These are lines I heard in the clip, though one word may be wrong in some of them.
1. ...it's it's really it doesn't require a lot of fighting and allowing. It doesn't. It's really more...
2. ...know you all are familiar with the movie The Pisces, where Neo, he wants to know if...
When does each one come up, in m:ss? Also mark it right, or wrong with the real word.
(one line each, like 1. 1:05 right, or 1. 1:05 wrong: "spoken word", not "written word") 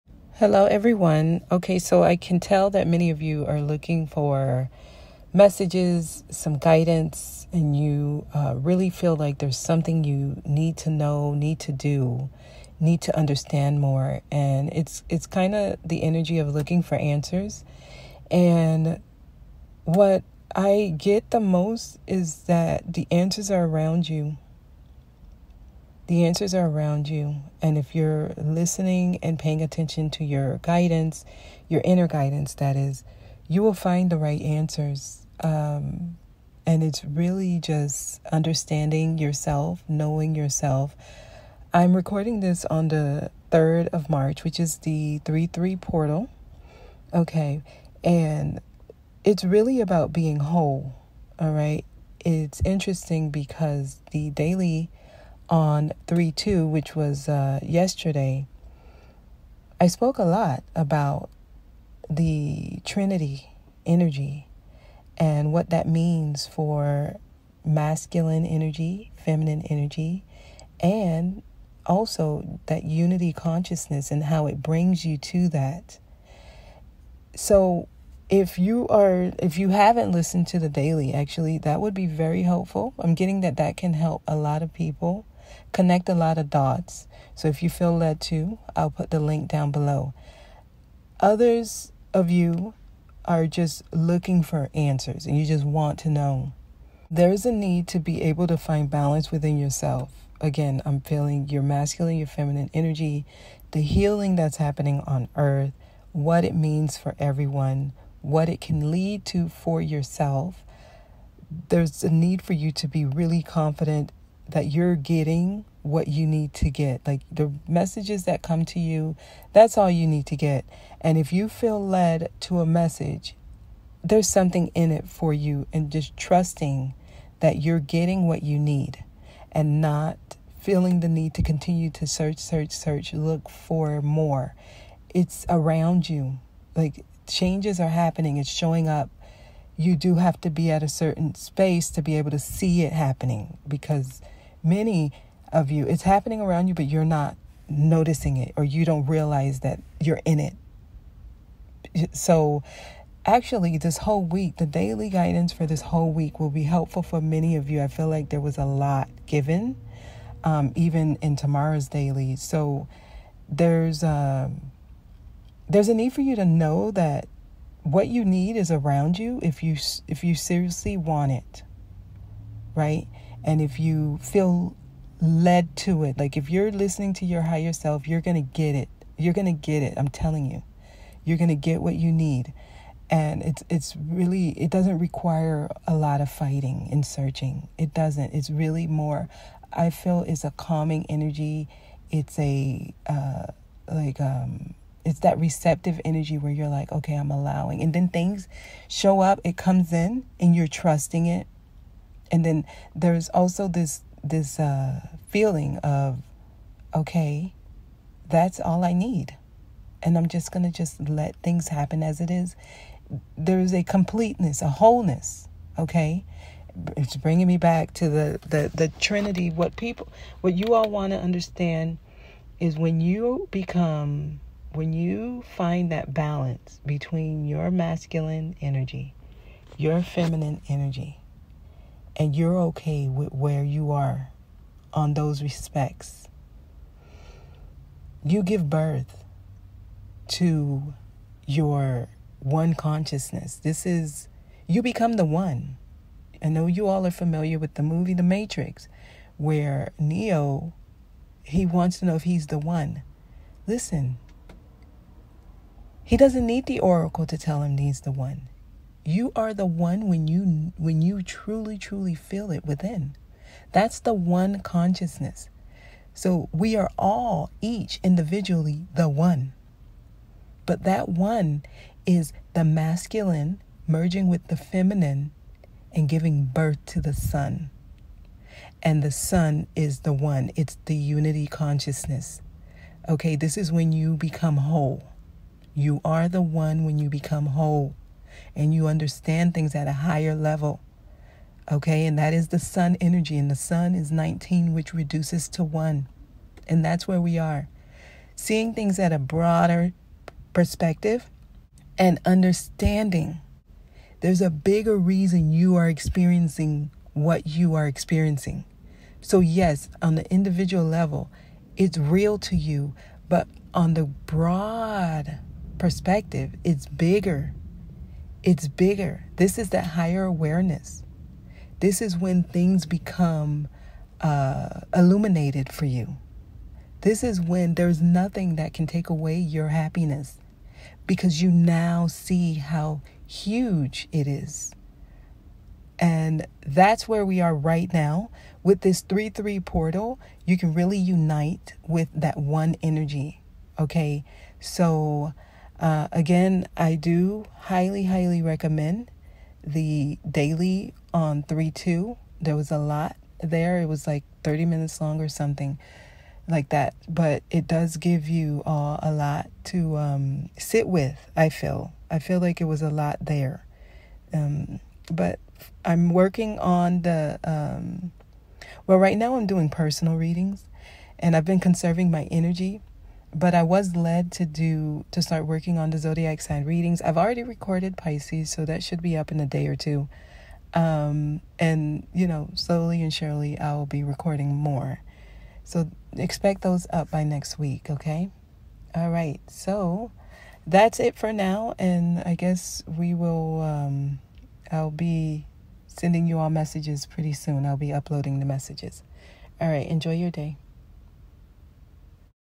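1. 3:03 wrong: "searching", not "allowing"
2. 4:06 wrong: "Matrix", not "Pisces".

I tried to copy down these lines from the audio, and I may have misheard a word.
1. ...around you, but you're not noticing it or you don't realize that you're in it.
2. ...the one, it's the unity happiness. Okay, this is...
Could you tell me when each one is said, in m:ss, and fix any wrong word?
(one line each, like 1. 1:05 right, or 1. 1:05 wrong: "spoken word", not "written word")
1. 2:26 right
2. 4:40 wrong: "consciousness", not "happiness".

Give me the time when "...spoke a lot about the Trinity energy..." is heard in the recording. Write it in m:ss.
0:59.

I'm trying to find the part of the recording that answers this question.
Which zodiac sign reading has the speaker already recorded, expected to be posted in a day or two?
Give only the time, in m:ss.
6:17.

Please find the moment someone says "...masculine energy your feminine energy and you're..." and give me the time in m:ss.
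3:47.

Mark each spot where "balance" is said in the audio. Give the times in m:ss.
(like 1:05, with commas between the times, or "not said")
1:38, 3:46.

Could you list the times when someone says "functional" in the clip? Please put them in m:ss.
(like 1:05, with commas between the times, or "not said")
not said.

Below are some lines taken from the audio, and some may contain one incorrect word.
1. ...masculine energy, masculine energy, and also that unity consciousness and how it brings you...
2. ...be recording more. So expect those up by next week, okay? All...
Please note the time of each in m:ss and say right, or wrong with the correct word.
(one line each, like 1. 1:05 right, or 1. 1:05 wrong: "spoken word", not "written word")
1. 1:07 wrong: "feminine", not "masculine"
2. 6:23 right.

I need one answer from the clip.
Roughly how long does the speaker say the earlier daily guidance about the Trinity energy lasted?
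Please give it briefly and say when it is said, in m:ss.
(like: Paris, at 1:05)
30 minutes, at 5:54.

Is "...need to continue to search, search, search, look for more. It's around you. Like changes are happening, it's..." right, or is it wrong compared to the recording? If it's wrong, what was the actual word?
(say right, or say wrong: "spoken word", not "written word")
right.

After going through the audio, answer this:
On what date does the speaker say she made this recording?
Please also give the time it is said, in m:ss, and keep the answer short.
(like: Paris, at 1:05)
3rd of March, at 0:43.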